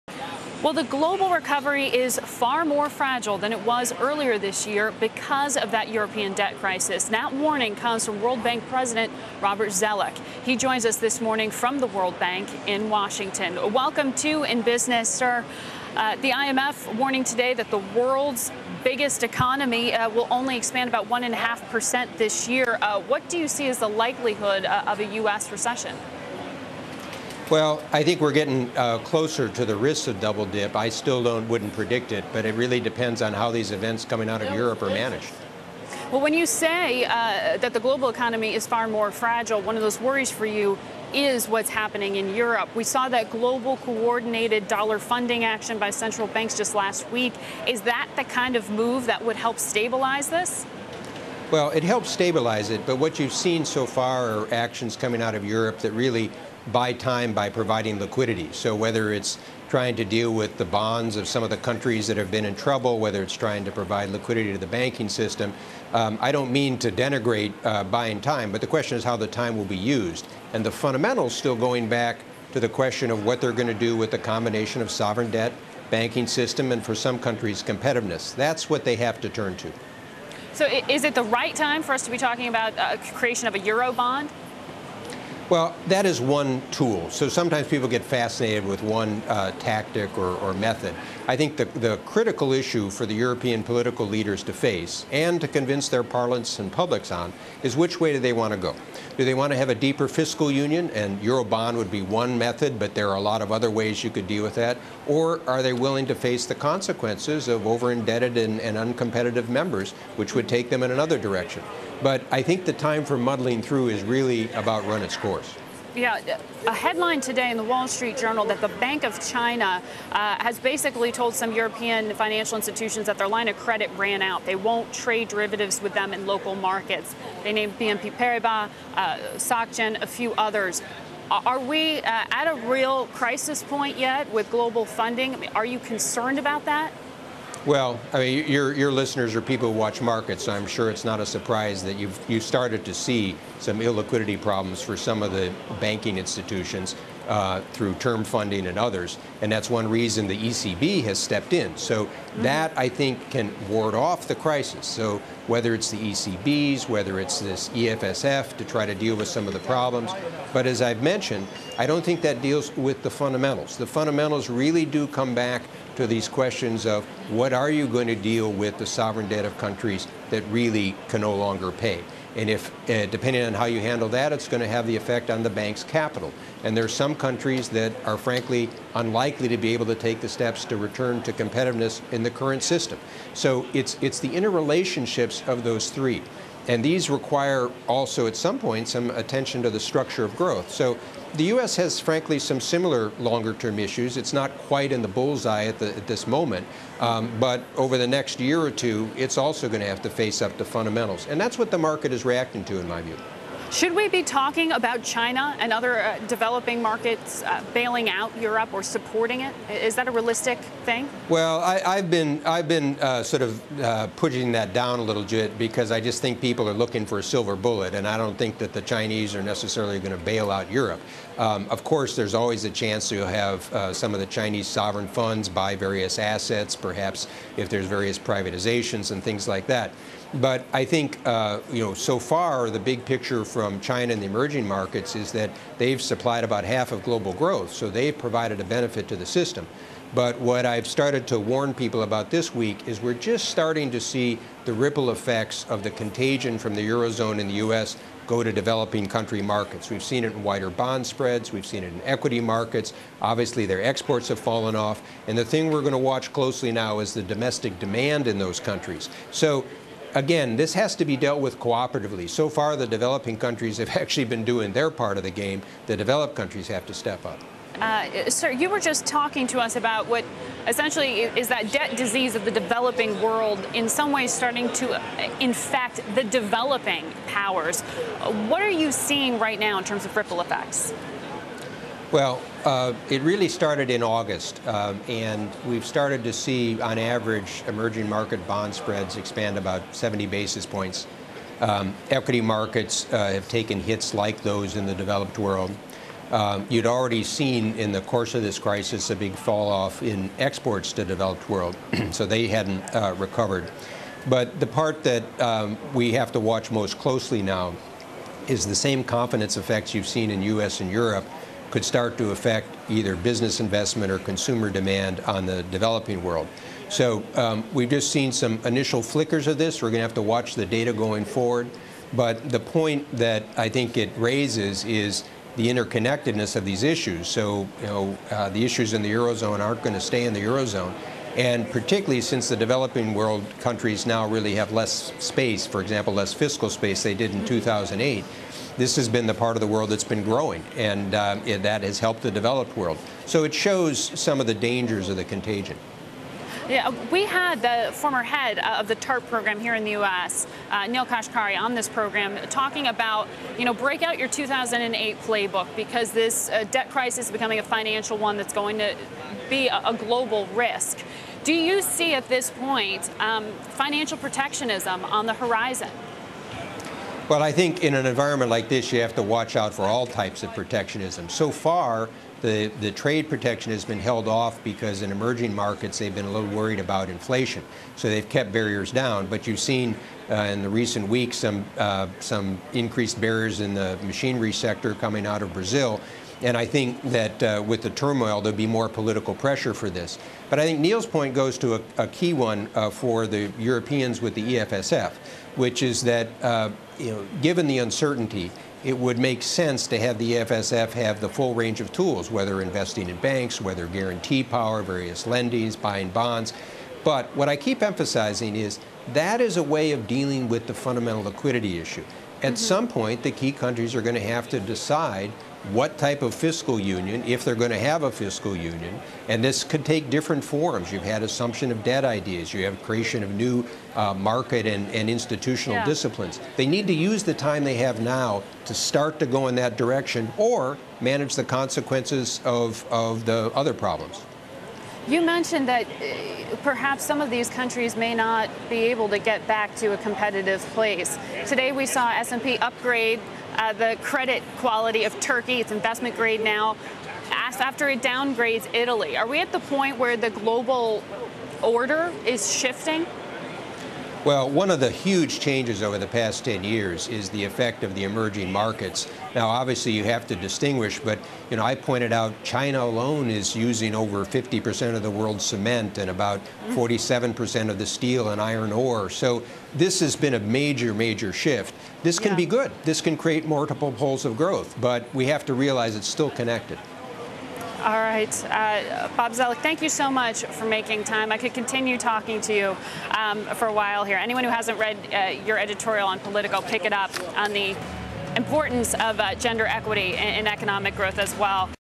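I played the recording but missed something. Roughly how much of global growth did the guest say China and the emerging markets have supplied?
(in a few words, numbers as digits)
about half.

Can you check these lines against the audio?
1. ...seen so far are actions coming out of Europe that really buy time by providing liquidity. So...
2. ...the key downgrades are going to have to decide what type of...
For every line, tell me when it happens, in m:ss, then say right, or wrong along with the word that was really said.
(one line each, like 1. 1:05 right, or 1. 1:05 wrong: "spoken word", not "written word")
1. 0:53 right
2. 6:53 wrong: "countries", not "downgrades".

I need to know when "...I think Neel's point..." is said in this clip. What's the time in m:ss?
6:30.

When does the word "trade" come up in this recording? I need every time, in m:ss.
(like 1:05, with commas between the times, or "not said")
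2:04, 6:12.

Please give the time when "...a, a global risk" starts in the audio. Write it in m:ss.
5:59.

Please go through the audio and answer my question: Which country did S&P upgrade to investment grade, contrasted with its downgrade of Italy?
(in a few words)
Turkey.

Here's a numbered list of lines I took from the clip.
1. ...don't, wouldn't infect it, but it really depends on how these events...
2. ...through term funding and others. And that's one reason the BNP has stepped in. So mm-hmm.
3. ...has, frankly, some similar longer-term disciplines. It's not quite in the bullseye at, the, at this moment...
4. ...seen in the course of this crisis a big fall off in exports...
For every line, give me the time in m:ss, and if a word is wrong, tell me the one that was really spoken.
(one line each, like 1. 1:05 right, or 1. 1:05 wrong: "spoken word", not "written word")
1. 0:31 wrong: "predict", not "infect"
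2. 2:27 wrong: "ECB", not "BNP"
3. 3:11 wrong: "issues", not "disciplines"
4. 4:57 right.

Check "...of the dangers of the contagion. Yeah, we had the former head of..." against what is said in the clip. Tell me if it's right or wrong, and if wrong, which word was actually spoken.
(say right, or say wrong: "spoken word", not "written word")
right.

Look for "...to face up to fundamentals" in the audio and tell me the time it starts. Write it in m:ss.
3:20.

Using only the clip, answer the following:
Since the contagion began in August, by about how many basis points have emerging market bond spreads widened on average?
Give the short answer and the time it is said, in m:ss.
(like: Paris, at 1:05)
70, at 4:49.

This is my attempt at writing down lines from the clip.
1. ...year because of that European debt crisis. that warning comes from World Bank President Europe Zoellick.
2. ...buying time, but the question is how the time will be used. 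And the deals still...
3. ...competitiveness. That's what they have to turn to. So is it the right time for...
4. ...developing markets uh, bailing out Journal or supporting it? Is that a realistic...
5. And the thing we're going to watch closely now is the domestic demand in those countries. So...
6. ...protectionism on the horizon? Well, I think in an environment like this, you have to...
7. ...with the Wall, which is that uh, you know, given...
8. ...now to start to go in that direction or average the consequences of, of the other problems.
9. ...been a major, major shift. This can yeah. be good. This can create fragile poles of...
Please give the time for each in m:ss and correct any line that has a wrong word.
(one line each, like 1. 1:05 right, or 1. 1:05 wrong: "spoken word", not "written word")
1. 0:04 wrong: "Robert", not "Europe"
2. 1:07 wrong: "fundamentals", not "deals"
3. 1:17 right
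4. 3:26 wrong: "Europe", not "Journal"
5. 4:15 right
6. 6:04 right
7. 6:34 wrong: "EFSF", not "Wall"
8. 7:08 wrong: "manage", not "average"
9. 7:50 wrong: "multiple", not "fragile".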